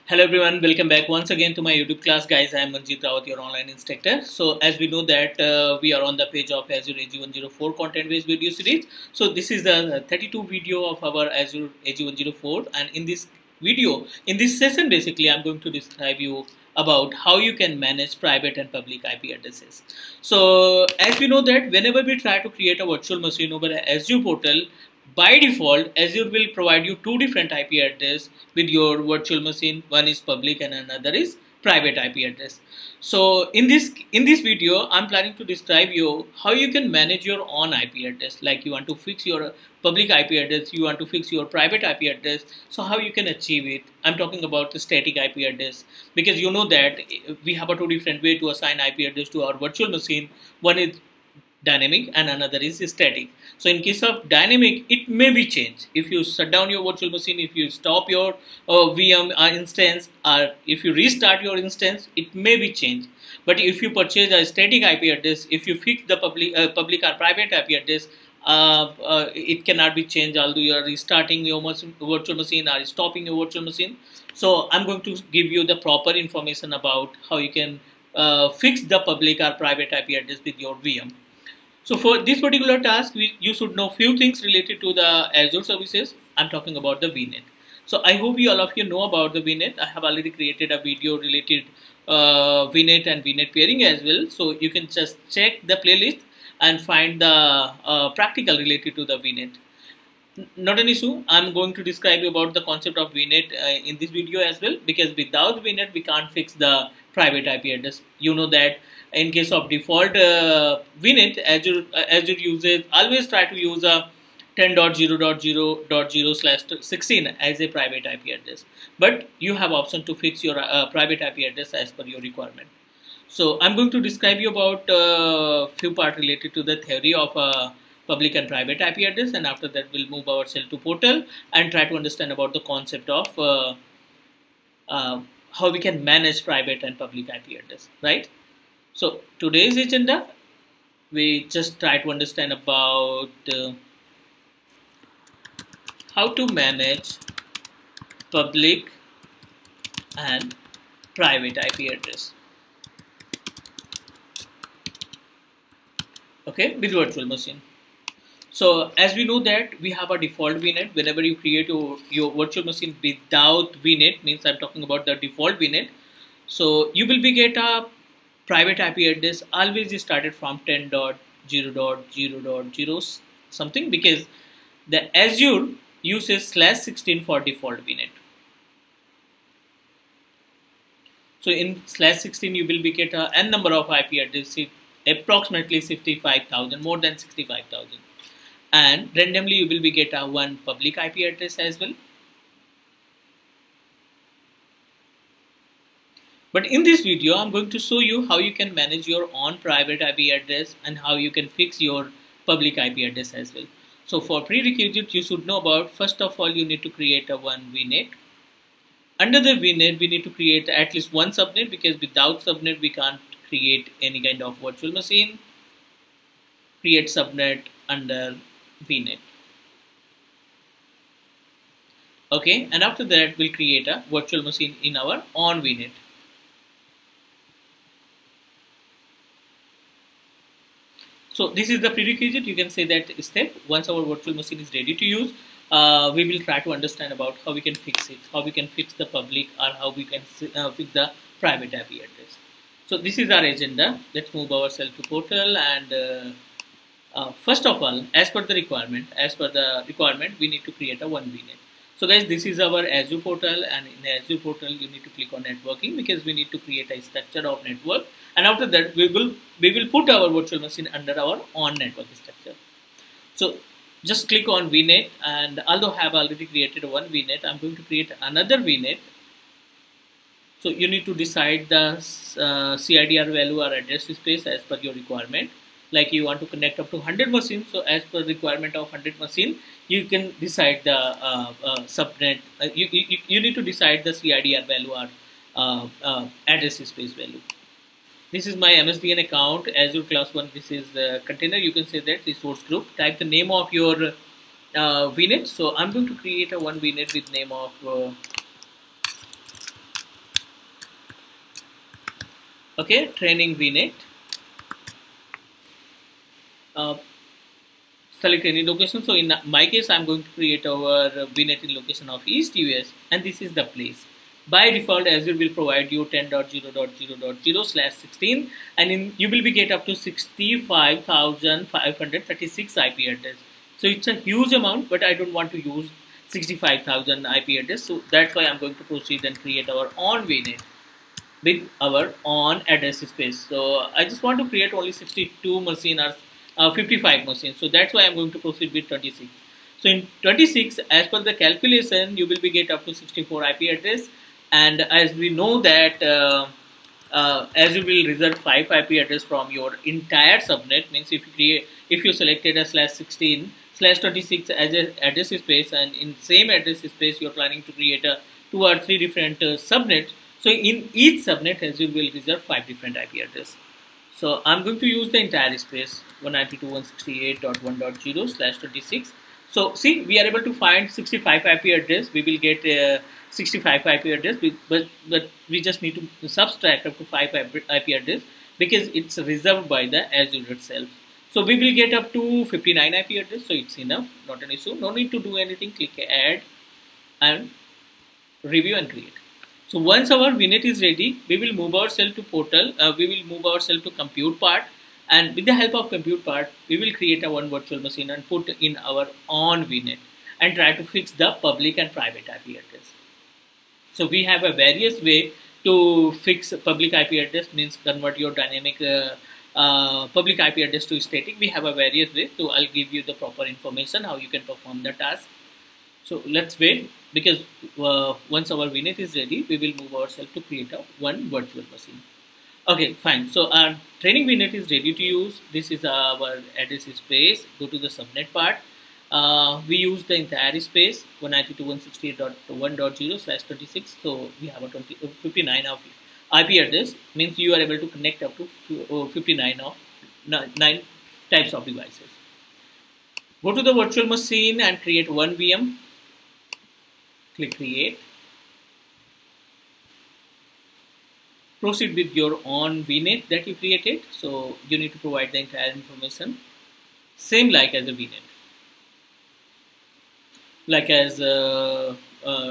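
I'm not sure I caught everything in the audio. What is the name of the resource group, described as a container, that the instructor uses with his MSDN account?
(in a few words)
Azure class 1.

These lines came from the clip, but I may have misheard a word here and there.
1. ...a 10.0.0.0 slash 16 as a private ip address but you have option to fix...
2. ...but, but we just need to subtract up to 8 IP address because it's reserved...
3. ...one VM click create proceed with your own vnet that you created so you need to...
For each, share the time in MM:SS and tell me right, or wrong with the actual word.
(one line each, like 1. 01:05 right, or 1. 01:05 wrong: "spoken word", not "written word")
1. 01:53 right
2. 06:14 wrong: "5", not "8"
3. 07:25 right.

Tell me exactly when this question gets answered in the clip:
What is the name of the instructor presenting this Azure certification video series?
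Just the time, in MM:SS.
00:02.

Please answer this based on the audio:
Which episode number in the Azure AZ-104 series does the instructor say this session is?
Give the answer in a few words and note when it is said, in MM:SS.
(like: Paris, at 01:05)
32, at 00:10.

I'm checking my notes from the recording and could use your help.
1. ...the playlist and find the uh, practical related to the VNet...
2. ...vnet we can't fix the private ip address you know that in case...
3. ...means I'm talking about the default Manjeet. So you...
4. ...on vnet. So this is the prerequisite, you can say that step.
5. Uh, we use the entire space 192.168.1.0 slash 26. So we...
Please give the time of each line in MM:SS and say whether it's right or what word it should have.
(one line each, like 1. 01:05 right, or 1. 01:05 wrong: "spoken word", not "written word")
1. 01:35 right
2. 01:45 right
3. 02:44 wrong: "VNet", not "Manjeet"
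4. 03:45 right
5. 07:09 right.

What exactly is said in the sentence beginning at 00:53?
So in case of dynamic, it may be changed.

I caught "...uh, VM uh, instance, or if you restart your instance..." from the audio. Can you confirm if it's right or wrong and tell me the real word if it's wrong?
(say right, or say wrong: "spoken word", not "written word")
right.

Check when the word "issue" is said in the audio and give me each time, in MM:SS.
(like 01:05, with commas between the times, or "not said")
01:40, 06:24.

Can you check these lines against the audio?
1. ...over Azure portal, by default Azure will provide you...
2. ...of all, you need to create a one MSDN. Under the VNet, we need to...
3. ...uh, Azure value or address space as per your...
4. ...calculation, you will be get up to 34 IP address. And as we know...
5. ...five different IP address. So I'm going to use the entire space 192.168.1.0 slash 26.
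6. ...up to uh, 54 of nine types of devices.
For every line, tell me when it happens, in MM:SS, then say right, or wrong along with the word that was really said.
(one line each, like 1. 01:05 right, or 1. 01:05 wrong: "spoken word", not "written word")
1. 00:23 right
2. 03:26 wrong: "VNet", not "MSDN"
3. 04:31 wrong: "CIDR", not "Azure"
4. 05:41 wrong: "64", not "34"
5. 06:02 right
6. 07:18 wrong: "59", not "54".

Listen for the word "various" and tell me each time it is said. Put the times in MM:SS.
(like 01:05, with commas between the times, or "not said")
06:44, 06:51.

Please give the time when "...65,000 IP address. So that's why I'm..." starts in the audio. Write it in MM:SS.
05:26.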